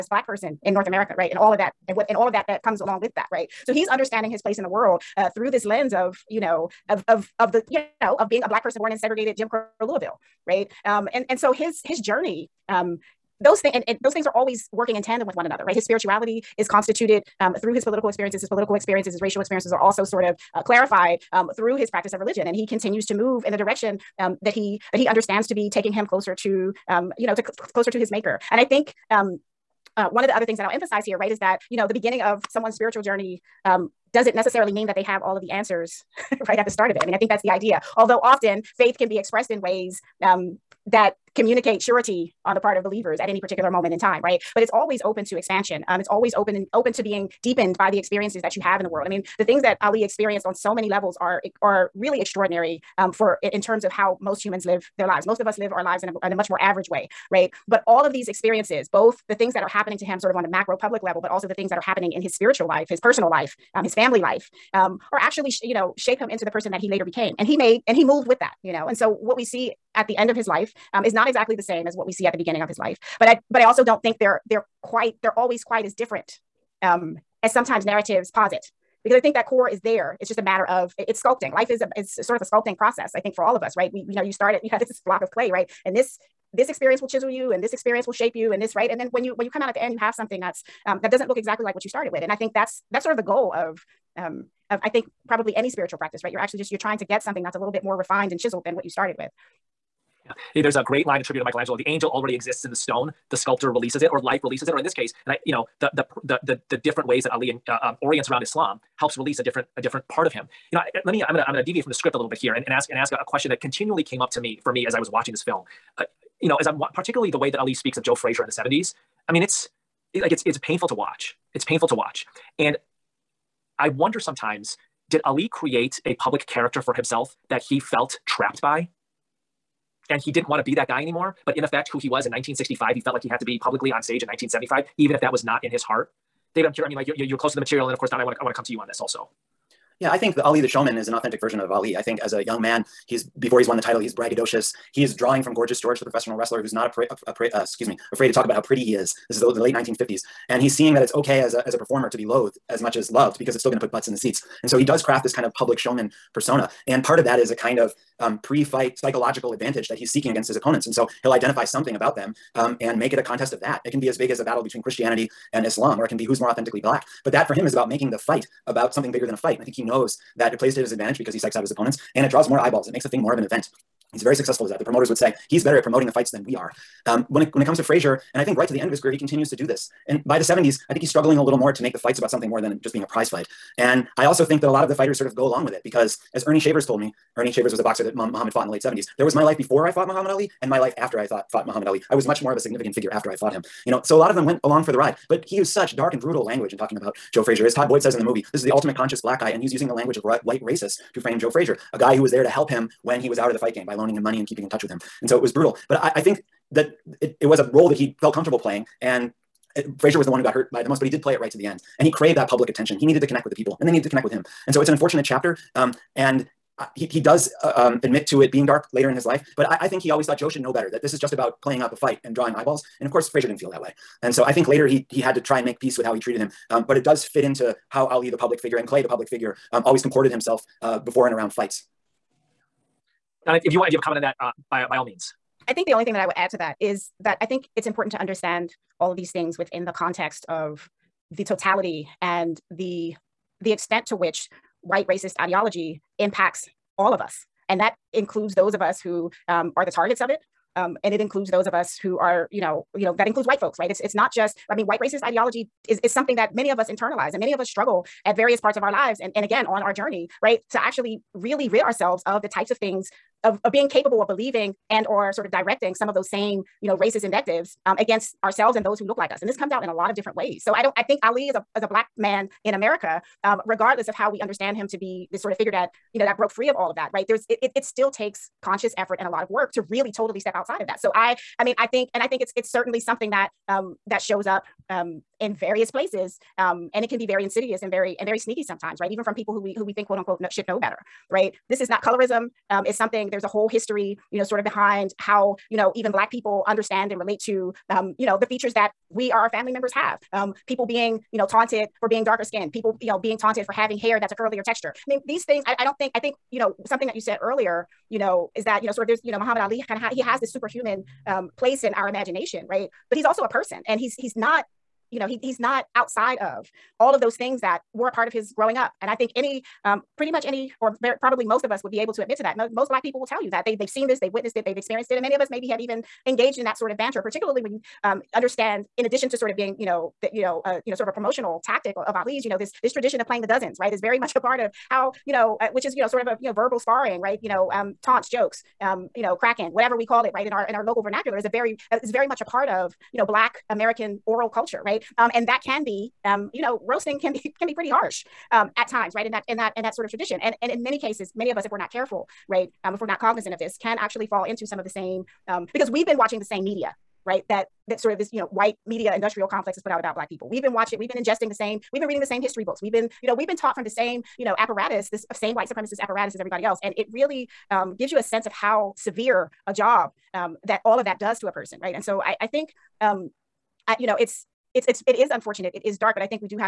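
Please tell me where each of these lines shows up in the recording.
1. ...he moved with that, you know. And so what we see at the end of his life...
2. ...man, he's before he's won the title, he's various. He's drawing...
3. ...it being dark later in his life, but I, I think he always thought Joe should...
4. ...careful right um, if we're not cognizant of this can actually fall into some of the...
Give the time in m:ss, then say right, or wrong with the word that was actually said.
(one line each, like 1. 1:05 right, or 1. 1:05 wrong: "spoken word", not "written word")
1. 1:07 right
2. 2:22 wrong: "braggadocious", not "various"
3. 3:38 right
4. 5:51 right.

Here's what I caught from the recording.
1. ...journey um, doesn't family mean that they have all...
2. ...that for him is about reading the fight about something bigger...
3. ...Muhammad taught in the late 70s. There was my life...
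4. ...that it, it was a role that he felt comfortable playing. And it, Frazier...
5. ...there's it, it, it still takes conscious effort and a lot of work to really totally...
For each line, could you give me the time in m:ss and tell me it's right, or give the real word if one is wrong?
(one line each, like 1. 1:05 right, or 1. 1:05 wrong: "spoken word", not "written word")
1. 0:33 wrong: "necessarily", not "family"
2. 2:47 wrong: "making", not "reading"
3. 3:08 wrong: "fought", not "taught"
4. 3:26 right
5. 4:37 right.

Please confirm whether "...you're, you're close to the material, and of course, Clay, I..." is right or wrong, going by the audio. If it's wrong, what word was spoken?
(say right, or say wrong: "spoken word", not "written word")
wrong: "Don", not "Clay".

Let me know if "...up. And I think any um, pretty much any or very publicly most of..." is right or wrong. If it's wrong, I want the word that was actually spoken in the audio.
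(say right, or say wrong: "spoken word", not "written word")
wrong: "probably", not "publicly".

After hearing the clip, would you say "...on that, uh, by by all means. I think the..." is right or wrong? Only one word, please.
right.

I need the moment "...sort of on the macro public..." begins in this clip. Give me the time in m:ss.
1:00.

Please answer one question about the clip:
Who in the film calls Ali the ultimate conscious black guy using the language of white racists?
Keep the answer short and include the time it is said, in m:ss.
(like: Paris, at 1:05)
Todd Boyd, at 3:17.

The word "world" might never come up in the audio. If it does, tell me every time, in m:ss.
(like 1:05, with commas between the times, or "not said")
0:04, 0:48.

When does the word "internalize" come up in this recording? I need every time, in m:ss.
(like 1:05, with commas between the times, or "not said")
4:16.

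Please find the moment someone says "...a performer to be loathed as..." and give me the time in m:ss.
2:31.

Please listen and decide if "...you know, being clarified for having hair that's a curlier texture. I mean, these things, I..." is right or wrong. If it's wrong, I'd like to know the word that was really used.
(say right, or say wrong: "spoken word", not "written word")
wrong: "taunted", not "clarified".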